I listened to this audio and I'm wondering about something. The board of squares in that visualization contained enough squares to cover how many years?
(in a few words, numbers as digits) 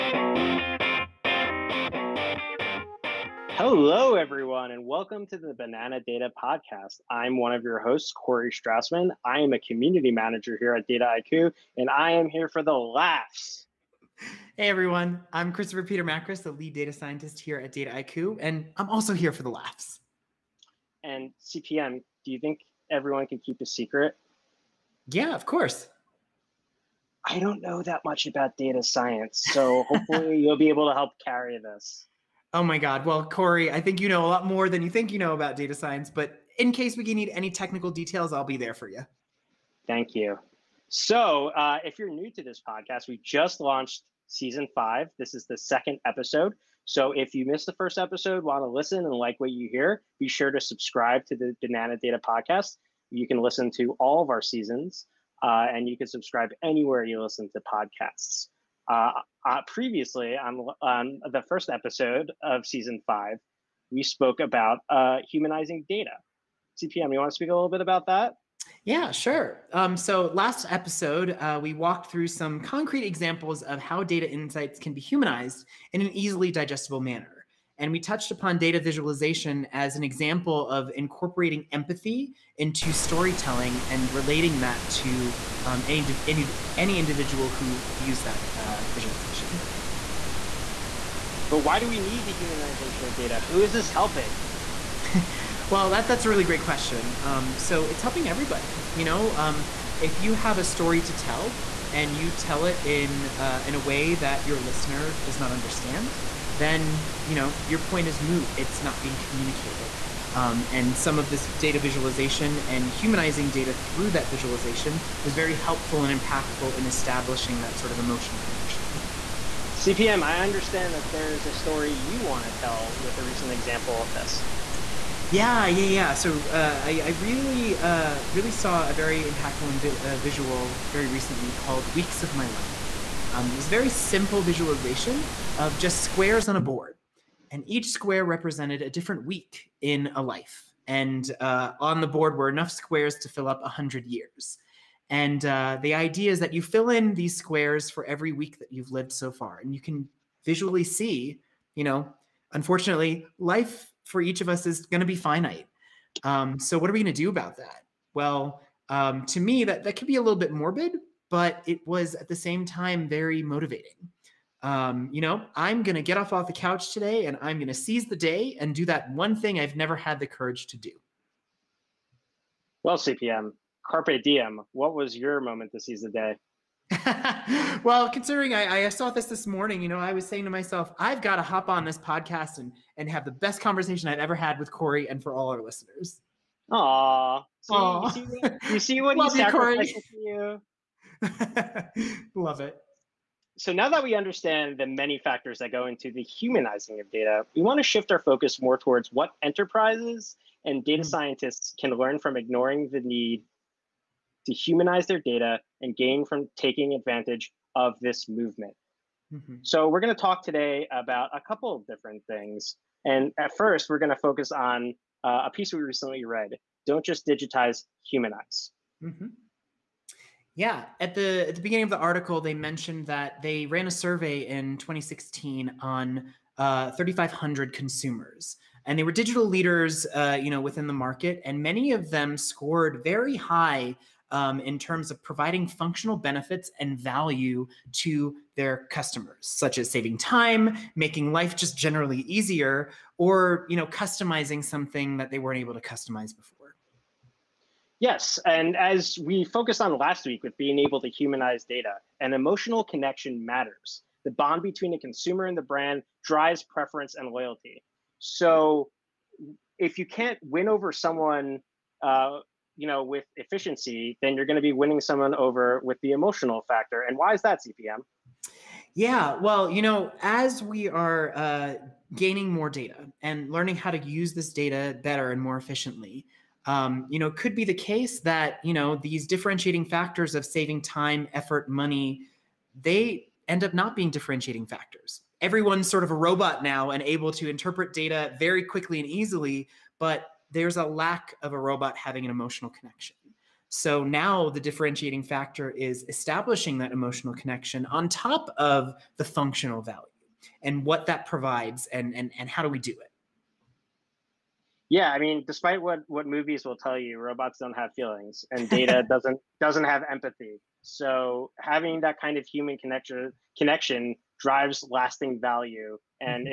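100.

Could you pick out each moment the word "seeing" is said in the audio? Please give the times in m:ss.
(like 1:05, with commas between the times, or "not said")
not said.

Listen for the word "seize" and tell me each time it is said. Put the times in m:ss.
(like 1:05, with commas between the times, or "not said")
2:47, 2:55.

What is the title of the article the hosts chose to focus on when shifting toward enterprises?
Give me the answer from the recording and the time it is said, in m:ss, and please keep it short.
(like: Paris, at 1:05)
Don't Just Digitize, Humanize, at 3:36.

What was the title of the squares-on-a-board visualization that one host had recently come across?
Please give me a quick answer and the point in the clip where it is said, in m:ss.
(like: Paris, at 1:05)
Weeks of My Life, at 2:11.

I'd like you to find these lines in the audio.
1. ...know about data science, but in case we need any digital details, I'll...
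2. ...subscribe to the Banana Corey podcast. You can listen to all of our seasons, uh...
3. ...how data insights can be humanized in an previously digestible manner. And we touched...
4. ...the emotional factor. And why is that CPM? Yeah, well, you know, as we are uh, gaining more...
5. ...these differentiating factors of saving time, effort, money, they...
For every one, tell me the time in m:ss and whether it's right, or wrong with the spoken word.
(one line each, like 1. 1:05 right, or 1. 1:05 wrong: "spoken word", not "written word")
1. 0:35 wrong: "technical", not "digital"
2. 0:50 wrong: "Data", not "Corey"
3. 1:13 wrong: "easily", not "previously"
4. 4:26 right
5. 4:38 right.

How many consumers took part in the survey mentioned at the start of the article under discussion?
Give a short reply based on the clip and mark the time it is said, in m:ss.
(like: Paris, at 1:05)
3,500, at 3:46.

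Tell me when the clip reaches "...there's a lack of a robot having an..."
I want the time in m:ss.
4:50.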